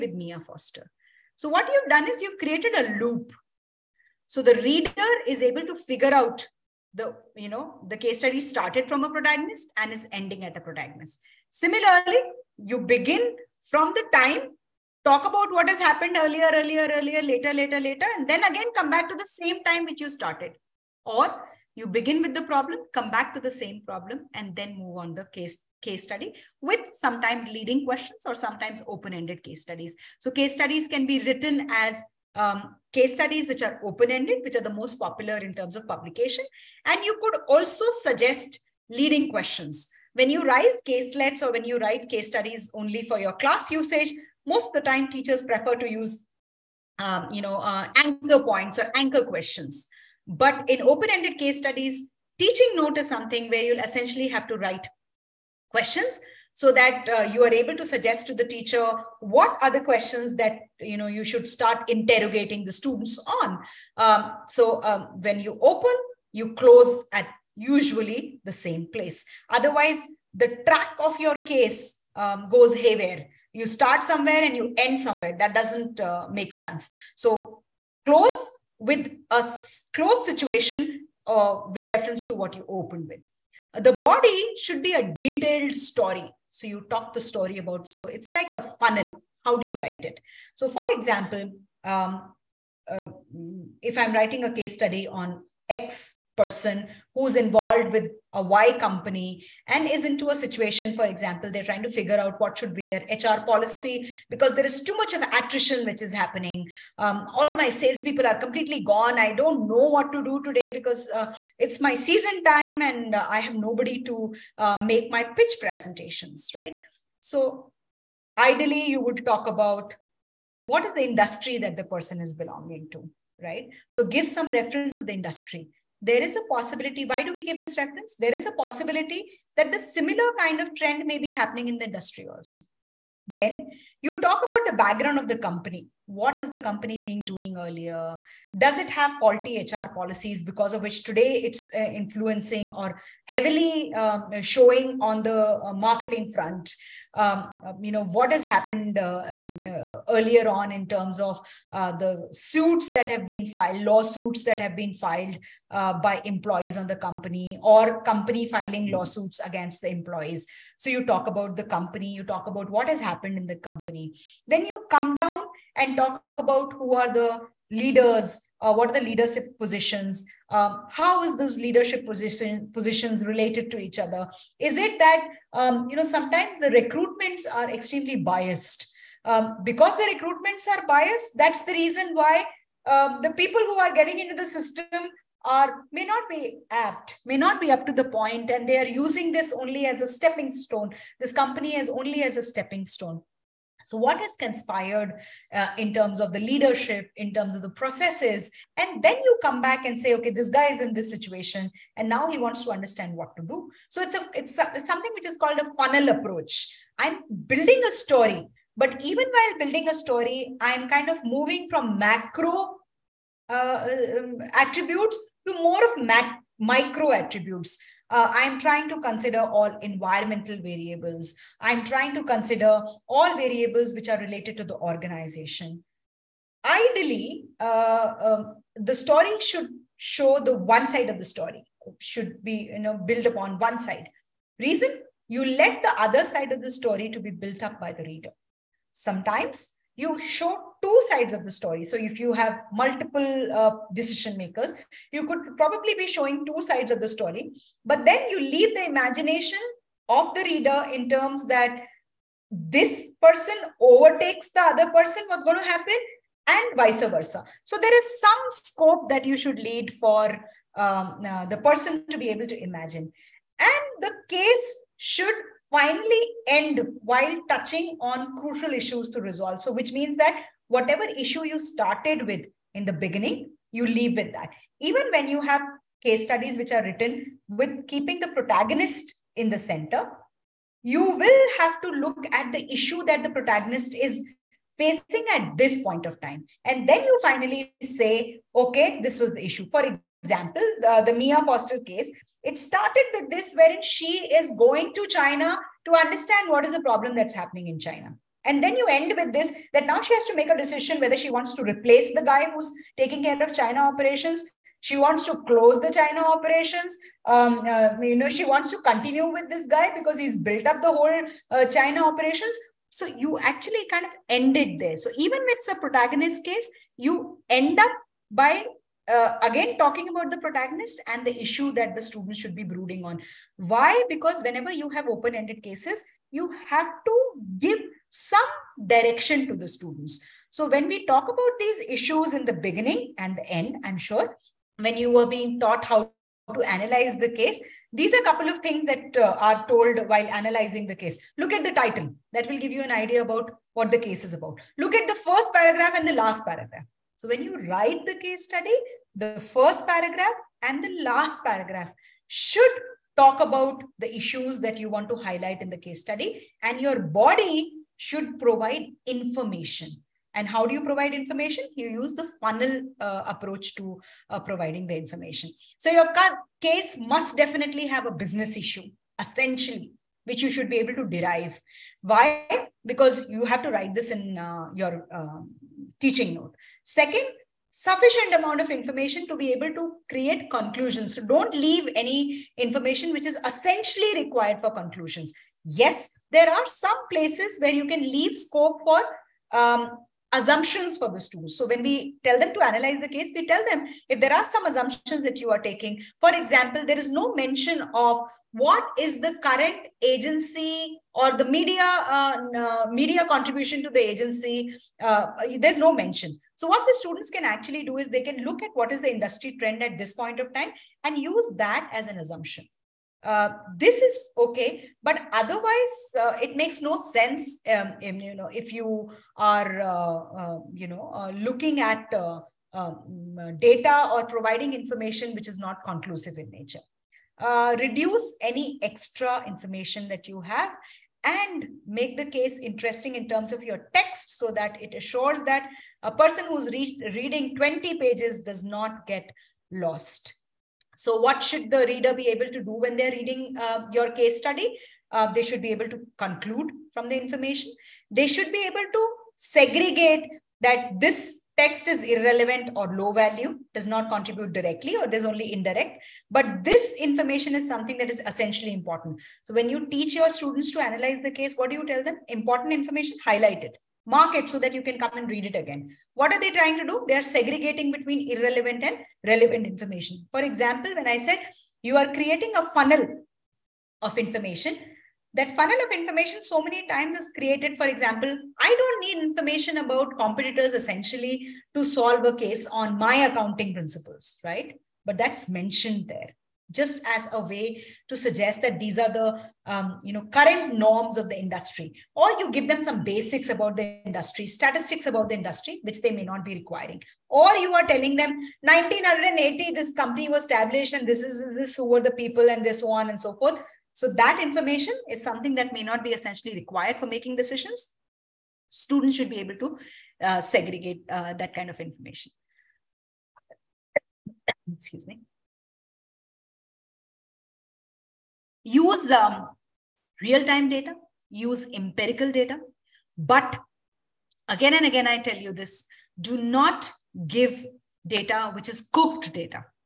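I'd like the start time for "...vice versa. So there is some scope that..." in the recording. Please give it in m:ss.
4:16.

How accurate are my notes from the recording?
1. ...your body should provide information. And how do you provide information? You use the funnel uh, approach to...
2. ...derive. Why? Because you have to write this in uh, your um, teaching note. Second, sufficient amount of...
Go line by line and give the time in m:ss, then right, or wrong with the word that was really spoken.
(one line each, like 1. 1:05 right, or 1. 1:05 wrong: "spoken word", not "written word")
1. 5:56 right
2. 6:11 right.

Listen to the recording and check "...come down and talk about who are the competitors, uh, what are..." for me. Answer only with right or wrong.
wrong.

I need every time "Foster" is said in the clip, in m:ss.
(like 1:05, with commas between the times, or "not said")
0:00, 4:51.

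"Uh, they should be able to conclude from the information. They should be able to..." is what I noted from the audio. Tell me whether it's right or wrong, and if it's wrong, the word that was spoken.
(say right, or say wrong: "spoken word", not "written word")
right.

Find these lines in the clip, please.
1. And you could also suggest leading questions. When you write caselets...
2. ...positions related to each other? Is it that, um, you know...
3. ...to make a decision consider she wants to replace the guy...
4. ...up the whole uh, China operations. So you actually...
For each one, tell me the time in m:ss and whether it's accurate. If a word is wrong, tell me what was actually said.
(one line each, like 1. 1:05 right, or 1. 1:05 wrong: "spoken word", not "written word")
1. 0:36 right
2. 2:52 right
3. 5:00 wrong: "whether", not "consider"
4. 5:10 right.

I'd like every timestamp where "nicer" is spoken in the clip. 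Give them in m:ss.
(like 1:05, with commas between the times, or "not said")
not said.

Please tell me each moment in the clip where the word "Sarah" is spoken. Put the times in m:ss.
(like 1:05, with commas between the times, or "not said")
not said.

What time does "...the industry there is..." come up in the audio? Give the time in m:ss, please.
2:05.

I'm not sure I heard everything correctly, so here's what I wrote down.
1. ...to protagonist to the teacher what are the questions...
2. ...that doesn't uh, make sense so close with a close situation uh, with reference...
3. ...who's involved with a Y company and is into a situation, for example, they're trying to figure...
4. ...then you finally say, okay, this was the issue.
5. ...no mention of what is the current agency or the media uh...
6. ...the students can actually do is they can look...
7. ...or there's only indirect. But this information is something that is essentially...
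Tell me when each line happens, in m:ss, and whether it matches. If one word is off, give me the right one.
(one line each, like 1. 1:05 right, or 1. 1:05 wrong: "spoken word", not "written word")
1. 0:57 wrong: "suggest", not "protagonist"
2. 1:15 right
3. 1:37 right
4. 4:46 right
5. 6:37 right
6. 6:46 right
7. 7:34 right.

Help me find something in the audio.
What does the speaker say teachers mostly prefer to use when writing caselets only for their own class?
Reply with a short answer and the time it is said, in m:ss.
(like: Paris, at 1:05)
anchor points, at 0:48.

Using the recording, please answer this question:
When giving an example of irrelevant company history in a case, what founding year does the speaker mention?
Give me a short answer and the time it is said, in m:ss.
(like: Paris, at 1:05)
1980, at 8:18.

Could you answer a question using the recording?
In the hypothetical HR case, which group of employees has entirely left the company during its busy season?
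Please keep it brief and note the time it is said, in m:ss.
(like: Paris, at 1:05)
salespeople, at 1:47.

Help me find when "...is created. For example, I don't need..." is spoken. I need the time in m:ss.
7:57.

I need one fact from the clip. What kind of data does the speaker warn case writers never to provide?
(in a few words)
cooked data.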